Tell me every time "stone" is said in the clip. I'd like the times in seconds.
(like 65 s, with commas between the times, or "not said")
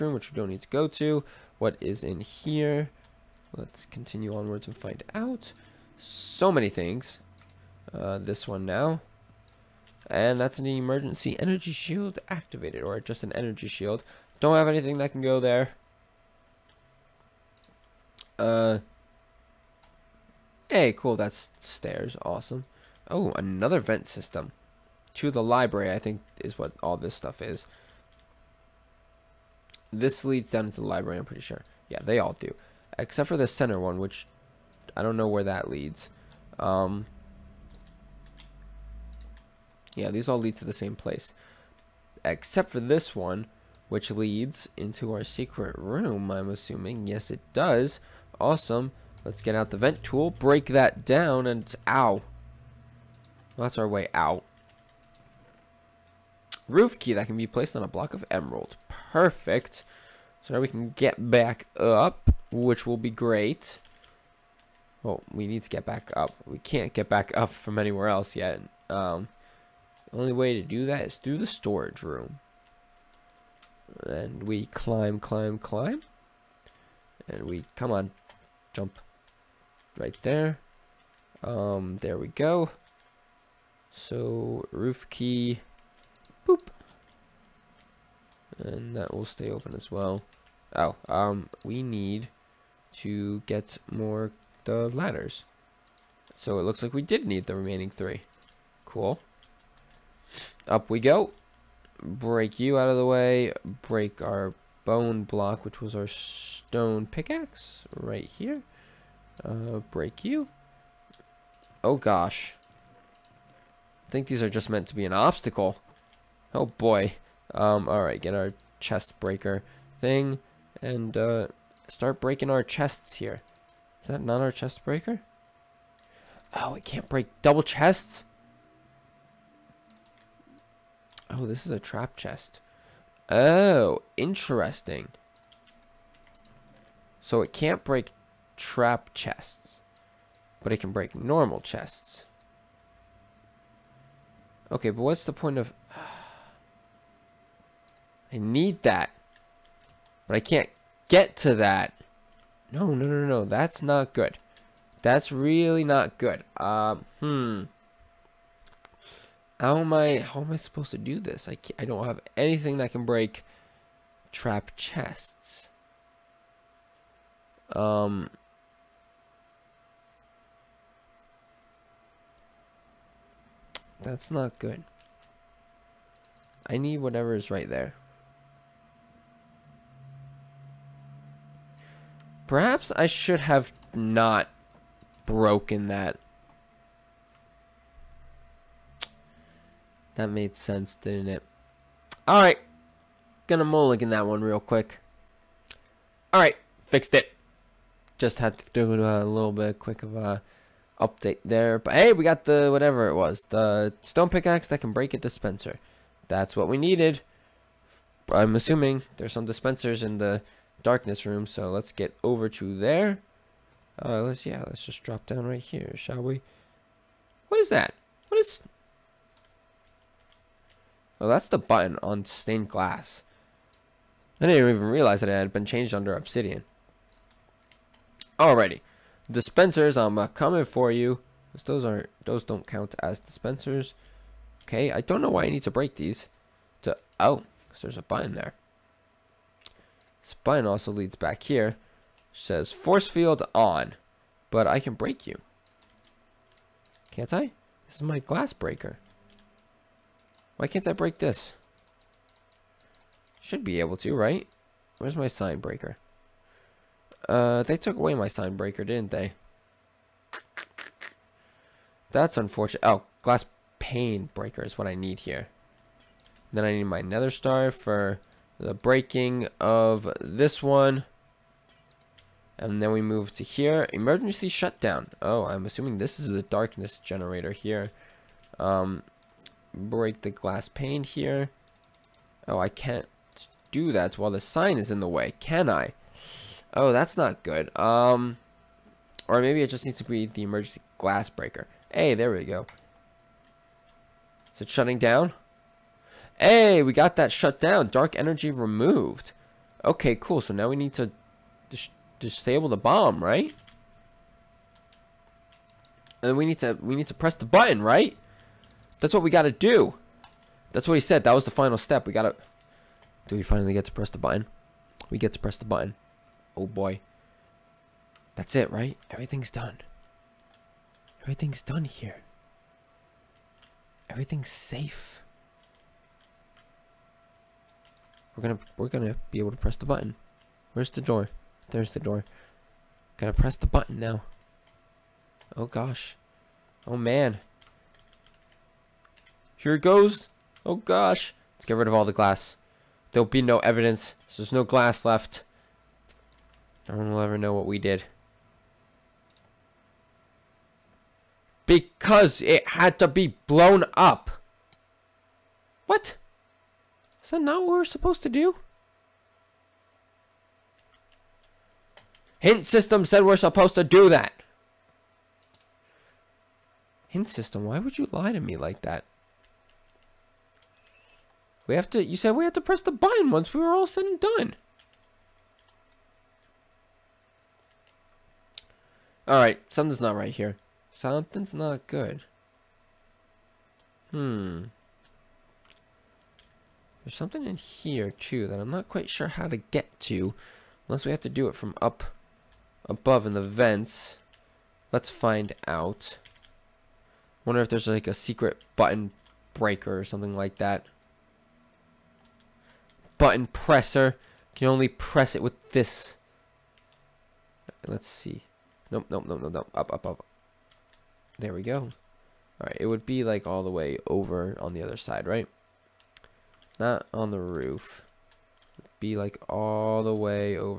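106 s, 204 s.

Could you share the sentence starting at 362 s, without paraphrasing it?
Hint system said we're supposed to do that.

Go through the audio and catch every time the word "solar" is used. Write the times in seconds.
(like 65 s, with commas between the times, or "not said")
not said.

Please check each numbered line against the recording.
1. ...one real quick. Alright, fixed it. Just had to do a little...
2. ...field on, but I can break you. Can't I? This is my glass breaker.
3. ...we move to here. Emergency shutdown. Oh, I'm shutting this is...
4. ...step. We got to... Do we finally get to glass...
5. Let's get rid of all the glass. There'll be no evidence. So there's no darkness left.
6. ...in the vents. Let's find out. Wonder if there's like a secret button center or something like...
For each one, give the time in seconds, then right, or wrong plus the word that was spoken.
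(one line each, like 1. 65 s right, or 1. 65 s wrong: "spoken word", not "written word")
1. 194 s right
2. 243 s right
3. 272 s wrong: "assuming", not "shutting"
4. 311 s wrong: "press", not "glass"
5. 341 s wrong: "glass", not "darkness"
6. 393 s wrong: "breaker", not "center".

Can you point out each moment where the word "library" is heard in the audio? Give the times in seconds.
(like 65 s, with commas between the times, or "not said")
25 s, 30 s.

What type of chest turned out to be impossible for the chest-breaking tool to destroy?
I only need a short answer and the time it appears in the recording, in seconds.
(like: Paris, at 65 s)
Trap chest, at 131 s.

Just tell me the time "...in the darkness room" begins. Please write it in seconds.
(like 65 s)
210 s.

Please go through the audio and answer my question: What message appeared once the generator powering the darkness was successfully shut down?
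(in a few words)
Dark energy removed.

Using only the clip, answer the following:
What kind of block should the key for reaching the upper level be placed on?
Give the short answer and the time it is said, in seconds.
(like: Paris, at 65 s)
Block of emerald, at 57 s.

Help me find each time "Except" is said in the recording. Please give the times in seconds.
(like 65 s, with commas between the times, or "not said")
32 s, 42 s.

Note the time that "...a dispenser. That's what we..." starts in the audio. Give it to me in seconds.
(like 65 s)
205 s.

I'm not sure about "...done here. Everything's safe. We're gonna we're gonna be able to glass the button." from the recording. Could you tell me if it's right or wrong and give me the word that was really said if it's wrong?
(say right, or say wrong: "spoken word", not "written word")
wrong: "press", not "glass".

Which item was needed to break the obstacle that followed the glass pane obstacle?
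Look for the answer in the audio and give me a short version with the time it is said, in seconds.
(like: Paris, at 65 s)
Nether star, at 267 s.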